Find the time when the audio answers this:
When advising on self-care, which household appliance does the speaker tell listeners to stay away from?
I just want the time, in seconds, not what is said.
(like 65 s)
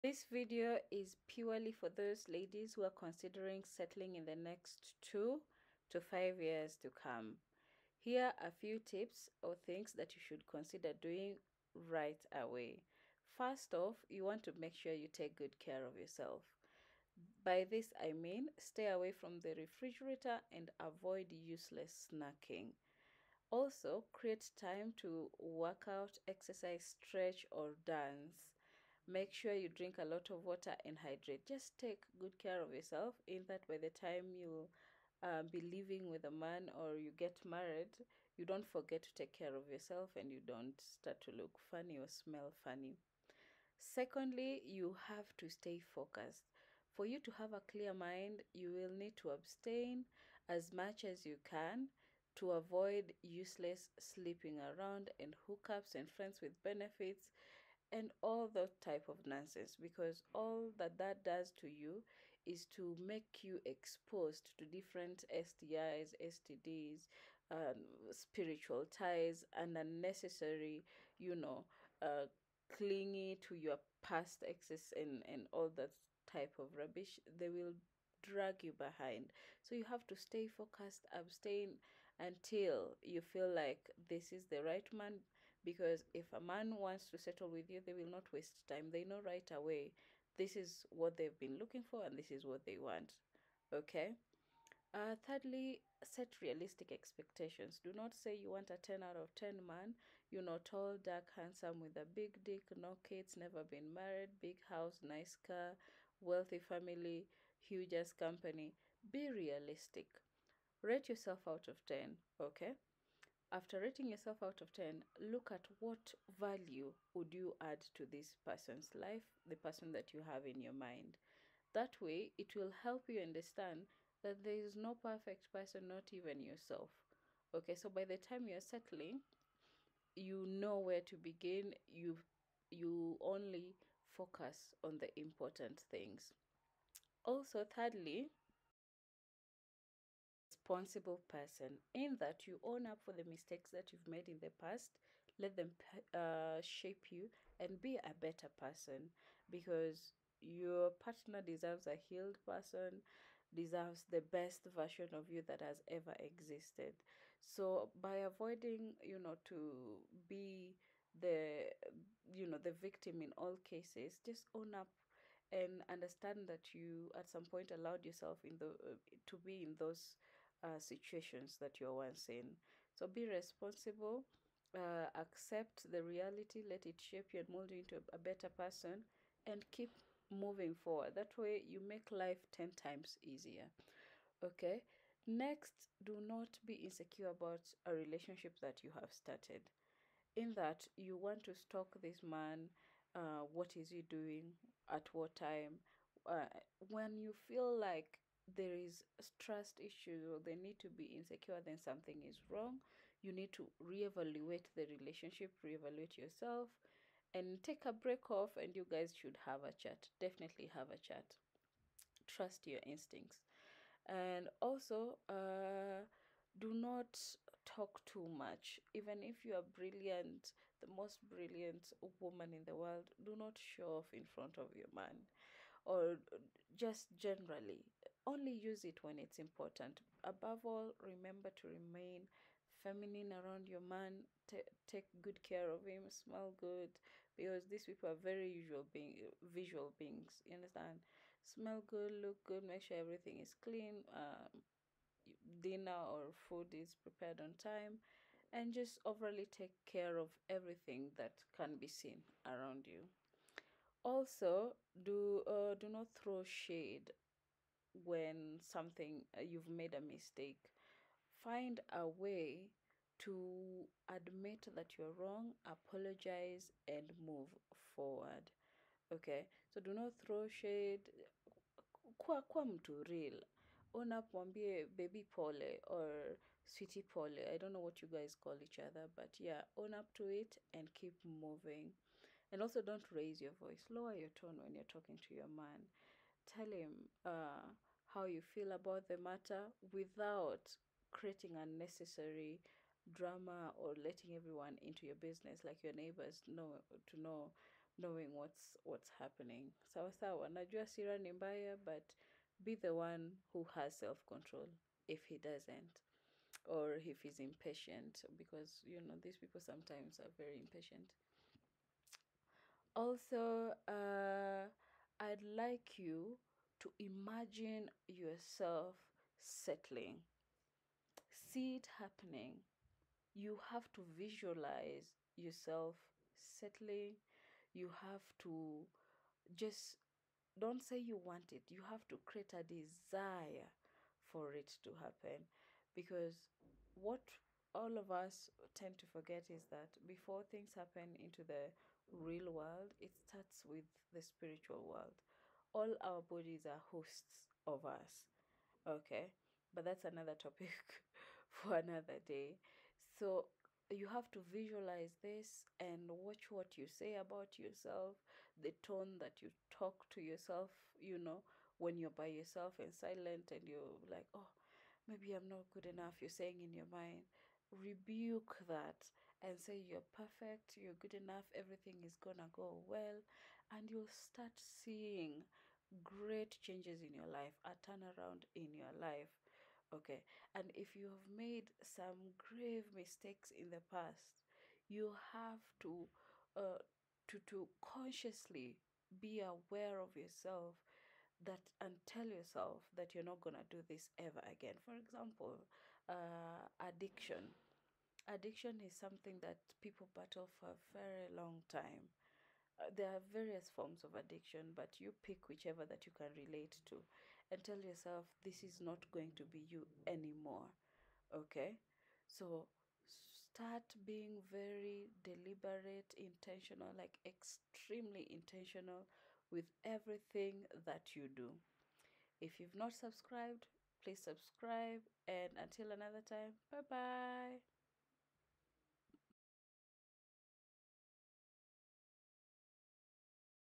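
19 s.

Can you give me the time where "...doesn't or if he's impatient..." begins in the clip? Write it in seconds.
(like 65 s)
305 s.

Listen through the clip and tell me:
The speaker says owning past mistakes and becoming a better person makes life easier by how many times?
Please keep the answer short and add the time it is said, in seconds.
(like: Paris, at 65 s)
10 times, at 182 s.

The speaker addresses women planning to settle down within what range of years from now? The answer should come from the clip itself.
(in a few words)
2 to 5 years.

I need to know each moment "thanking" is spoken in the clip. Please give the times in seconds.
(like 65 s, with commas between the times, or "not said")
not said.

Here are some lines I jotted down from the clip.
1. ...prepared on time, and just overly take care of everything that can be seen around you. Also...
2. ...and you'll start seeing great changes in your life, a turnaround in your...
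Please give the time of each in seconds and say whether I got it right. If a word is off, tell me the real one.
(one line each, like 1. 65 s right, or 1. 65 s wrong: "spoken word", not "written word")
1. 247 s right
2. 373 s right.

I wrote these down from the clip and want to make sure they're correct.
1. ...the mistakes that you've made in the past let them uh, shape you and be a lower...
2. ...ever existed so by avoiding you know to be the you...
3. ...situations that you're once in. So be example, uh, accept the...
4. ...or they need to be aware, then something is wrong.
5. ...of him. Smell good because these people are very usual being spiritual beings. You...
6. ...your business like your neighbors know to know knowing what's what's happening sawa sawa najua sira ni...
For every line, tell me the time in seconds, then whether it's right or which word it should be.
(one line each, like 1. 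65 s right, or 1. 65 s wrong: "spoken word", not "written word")
1. 143 s wrong: "better", not "lower"
2. 155 s right
3. 170 s wrong: "responsible", not "example"
4. 200 s wrong: "insecure", not "aware"
5. 235 s wrong: "visual", not "spiritual"
6. 295 s right.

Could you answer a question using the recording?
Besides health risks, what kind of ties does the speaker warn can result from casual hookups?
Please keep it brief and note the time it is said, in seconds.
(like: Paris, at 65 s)
spiritual ties, at 68 s.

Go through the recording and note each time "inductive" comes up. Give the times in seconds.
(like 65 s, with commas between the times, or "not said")
not said.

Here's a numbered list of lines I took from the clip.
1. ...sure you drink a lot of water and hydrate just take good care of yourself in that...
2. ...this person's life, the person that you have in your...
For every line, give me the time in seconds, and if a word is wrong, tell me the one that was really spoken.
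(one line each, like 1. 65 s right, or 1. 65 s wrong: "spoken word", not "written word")
1. 29 s right
2. 118 s right.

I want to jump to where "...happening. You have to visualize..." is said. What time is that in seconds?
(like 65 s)
321 s.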